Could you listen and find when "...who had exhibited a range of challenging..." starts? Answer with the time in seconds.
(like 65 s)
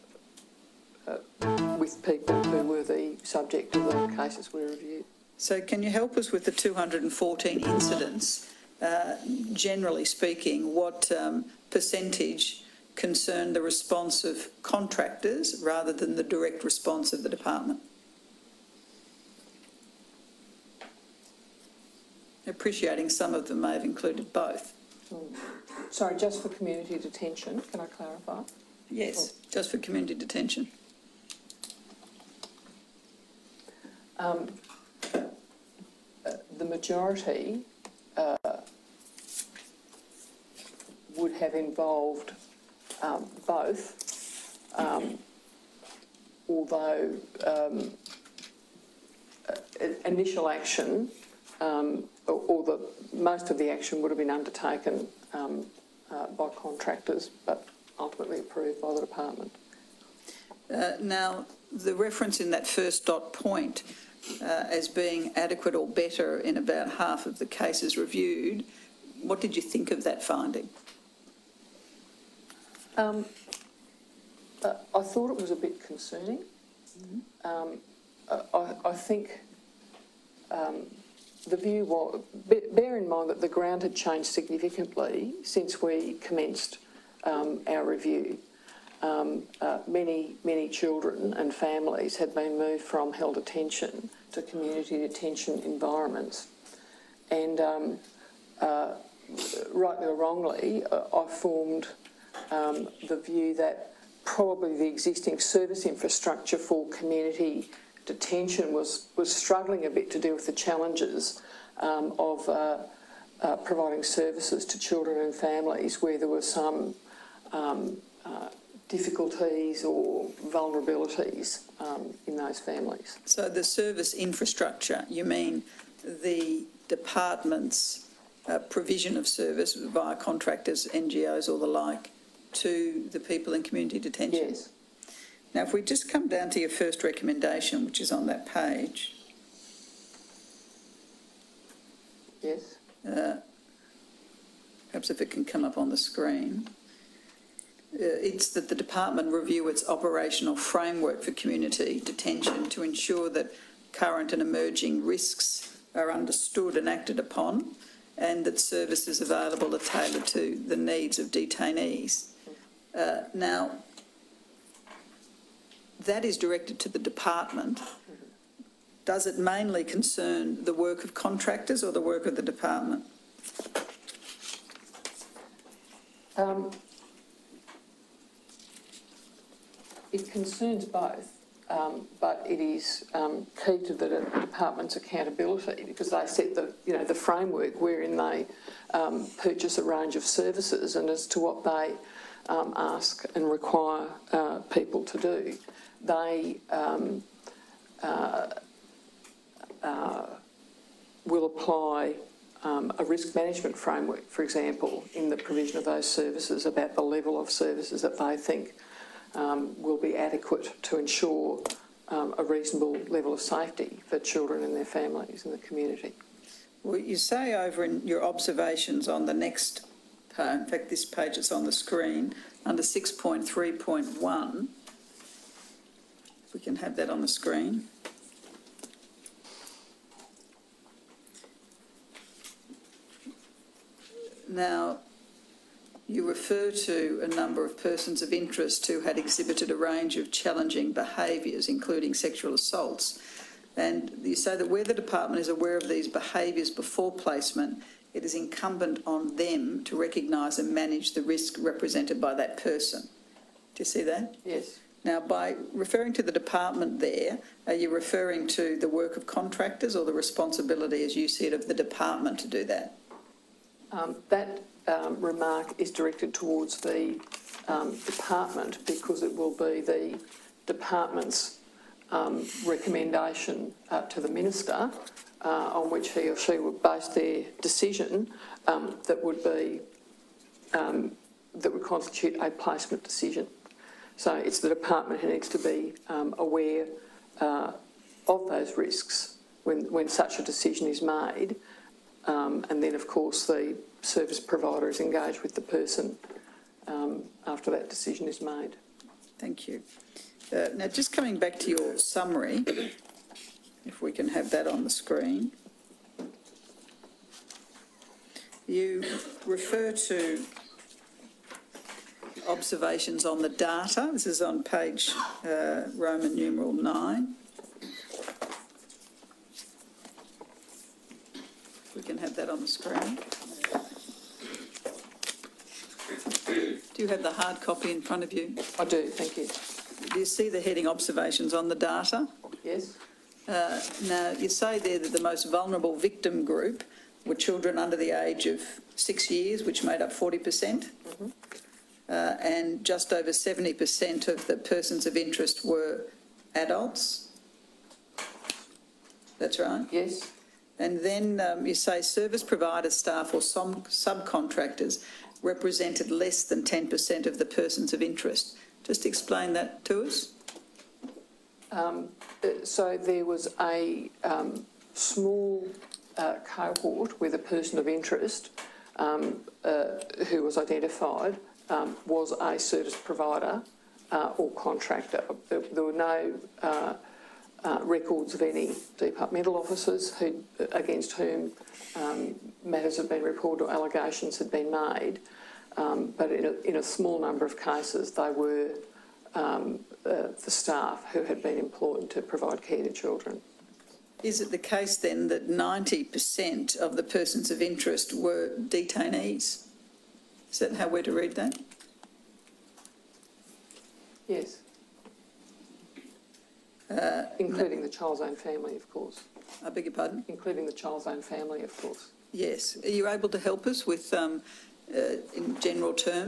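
238 s.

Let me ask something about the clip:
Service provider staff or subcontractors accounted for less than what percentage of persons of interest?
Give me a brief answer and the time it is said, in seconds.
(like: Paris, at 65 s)
10%, at 356 s.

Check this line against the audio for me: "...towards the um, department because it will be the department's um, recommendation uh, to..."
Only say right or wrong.
right.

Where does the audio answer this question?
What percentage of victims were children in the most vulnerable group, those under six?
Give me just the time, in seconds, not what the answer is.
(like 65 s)
340 s.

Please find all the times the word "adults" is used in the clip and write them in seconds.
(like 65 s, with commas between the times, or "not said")
346 s.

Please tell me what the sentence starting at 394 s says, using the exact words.
Is it the case then that 90% of the persons of interest were detainees?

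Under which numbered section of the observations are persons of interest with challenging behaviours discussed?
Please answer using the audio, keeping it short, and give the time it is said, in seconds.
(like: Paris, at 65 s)
6.3.1, at 222 s.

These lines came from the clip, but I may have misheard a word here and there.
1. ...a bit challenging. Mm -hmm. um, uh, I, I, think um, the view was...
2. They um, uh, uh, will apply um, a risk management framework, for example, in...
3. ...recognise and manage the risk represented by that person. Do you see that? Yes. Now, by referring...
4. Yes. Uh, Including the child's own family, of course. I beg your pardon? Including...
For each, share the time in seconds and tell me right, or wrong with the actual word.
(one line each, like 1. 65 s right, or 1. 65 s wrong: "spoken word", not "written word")
1. 75 s wrong: "concerning", not "challenging"
2. 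196 s right
3. 249 s right
4. 404 s right.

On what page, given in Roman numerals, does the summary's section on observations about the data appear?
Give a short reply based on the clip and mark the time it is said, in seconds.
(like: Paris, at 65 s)
9, at 315 s.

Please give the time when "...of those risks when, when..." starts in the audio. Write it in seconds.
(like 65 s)
288 s.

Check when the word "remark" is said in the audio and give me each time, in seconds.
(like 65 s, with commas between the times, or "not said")
265 s.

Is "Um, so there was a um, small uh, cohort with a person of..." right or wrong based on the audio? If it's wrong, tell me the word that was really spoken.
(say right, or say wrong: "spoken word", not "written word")
right.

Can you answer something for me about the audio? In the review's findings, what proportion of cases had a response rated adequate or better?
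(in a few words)
about half.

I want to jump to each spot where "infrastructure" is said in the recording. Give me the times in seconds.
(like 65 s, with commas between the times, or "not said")
105 s, 124 s.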